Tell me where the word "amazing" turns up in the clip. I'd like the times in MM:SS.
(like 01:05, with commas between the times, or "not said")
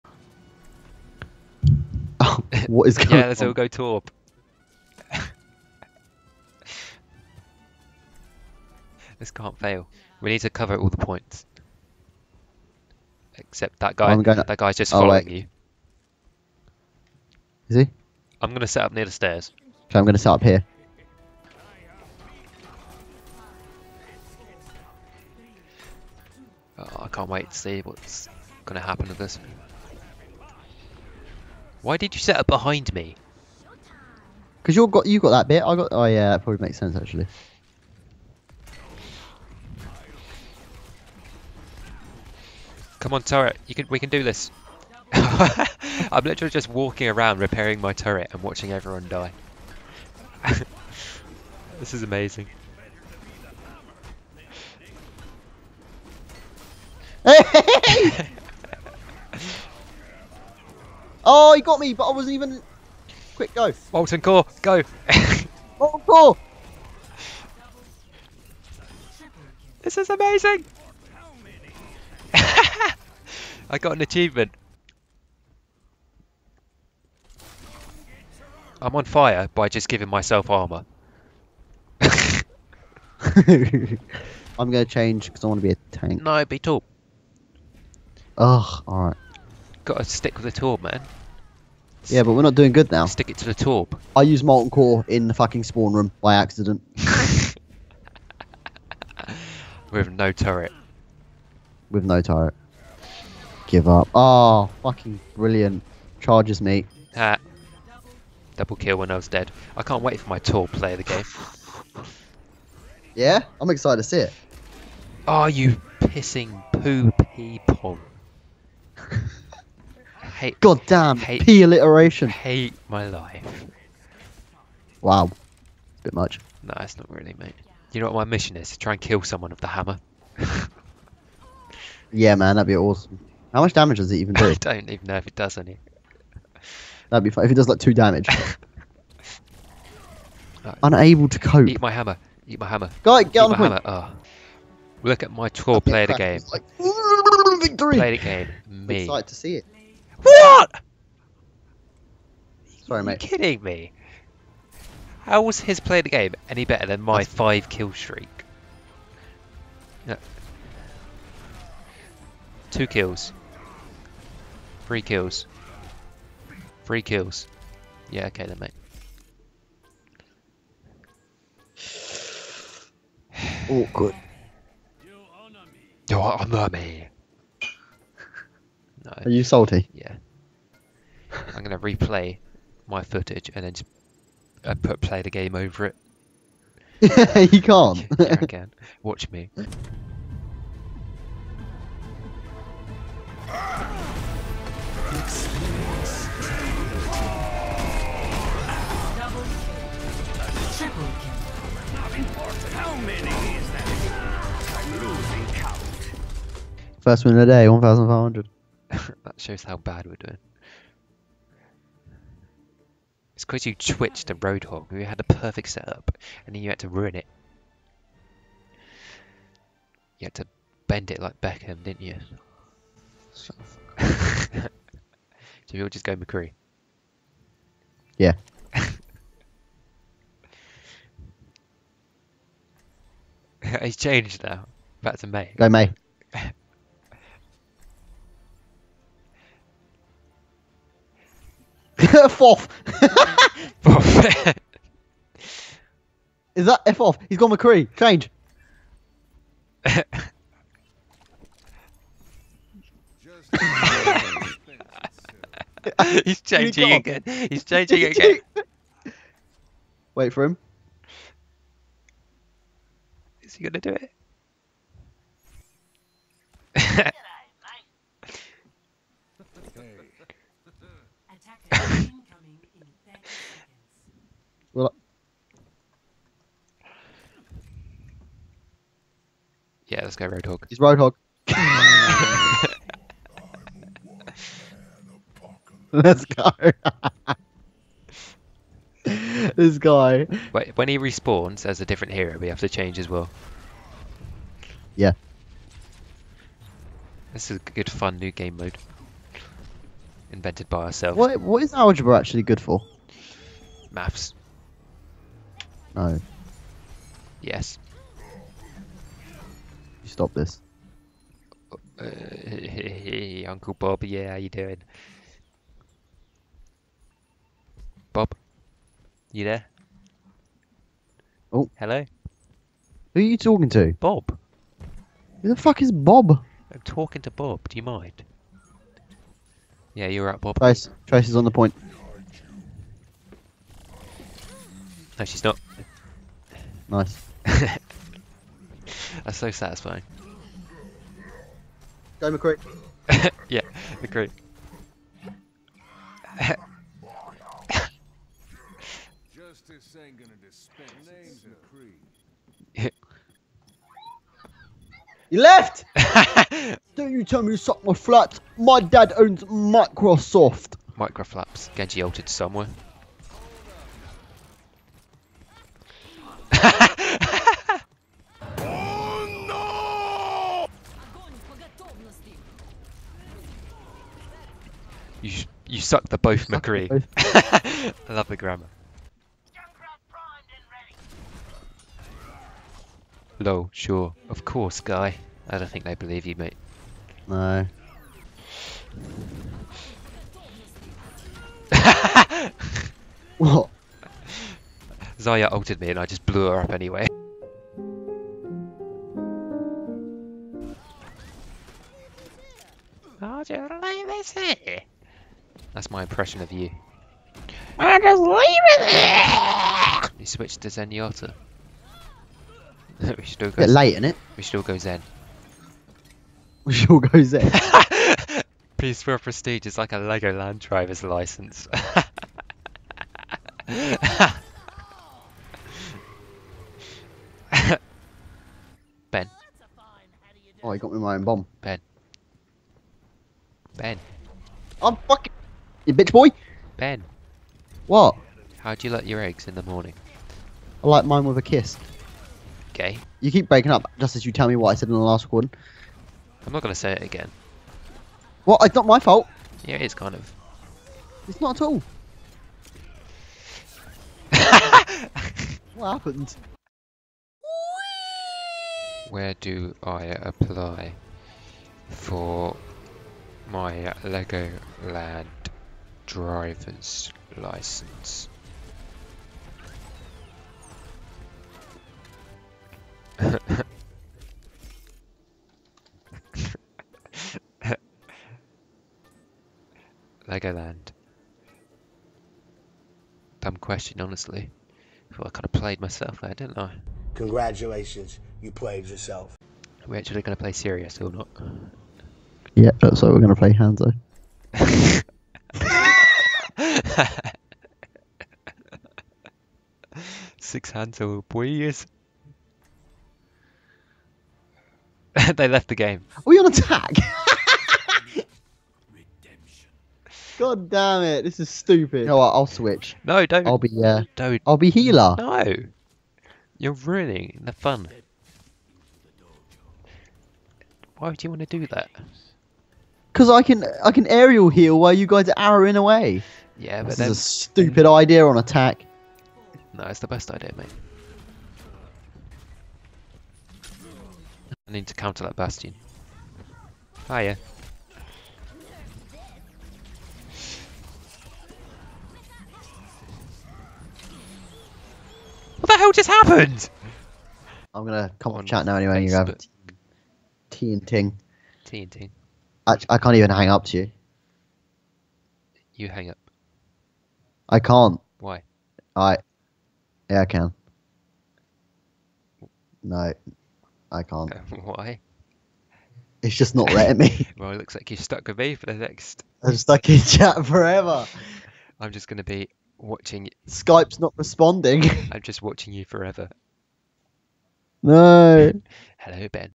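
00:52, 01:10.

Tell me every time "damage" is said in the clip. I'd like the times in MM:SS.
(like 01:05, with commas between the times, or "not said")
02:13, 02:17.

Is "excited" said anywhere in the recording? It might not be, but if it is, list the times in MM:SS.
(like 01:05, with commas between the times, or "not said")
01:53, 02:29.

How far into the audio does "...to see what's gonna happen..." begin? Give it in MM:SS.
00:27.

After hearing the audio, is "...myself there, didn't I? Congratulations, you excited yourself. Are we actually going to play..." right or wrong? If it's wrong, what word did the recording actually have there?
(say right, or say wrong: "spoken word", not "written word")
wrong: "played", not "excited".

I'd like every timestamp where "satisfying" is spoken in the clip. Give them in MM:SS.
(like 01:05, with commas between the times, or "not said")
05:39.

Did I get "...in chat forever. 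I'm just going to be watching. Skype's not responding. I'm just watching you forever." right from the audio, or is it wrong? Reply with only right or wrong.
right.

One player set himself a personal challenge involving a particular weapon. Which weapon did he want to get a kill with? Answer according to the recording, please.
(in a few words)
The hammer.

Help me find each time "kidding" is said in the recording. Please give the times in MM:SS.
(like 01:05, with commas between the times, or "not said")
02:33.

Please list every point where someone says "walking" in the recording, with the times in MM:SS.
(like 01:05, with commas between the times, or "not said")
00:46.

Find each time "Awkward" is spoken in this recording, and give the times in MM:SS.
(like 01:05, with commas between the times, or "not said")
02:53.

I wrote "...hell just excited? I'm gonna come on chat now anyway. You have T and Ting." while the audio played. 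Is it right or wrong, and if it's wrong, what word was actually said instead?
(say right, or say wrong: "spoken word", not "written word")
wrong: "happened", not "excited".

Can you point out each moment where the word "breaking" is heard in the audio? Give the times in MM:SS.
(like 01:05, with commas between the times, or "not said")
07:23.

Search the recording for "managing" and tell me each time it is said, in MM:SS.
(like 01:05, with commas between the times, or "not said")
not said.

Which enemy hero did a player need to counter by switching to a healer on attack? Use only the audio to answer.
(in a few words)
Bastion.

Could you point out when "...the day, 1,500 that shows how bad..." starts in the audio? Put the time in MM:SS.
03:27.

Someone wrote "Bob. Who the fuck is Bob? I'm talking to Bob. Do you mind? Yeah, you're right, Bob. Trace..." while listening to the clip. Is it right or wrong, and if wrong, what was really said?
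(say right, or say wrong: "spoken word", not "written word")
right.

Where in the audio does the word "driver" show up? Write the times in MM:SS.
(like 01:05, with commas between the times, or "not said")
07:00, 07:46.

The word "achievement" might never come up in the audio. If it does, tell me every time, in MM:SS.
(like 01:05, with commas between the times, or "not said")
01:14.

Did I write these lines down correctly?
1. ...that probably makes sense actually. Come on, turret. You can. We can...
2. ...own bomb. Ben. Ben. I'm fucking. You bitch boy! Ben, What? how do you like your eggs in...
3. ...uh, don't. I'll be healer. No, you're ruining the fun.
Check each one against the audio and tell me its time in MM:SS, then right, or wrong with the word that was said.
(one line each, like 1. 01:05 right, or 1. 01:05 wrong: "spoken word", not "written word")
1. 00:36 right
2. 07:11 right
3. 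08:33 right.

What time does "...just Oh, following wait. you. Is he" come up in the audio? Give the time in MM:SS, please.
00:14.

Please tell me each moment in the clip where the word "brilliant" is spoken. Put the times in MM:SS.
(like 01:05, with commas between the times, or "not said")
01:45.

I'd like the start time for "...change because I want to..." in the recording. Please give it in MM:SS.
01:24.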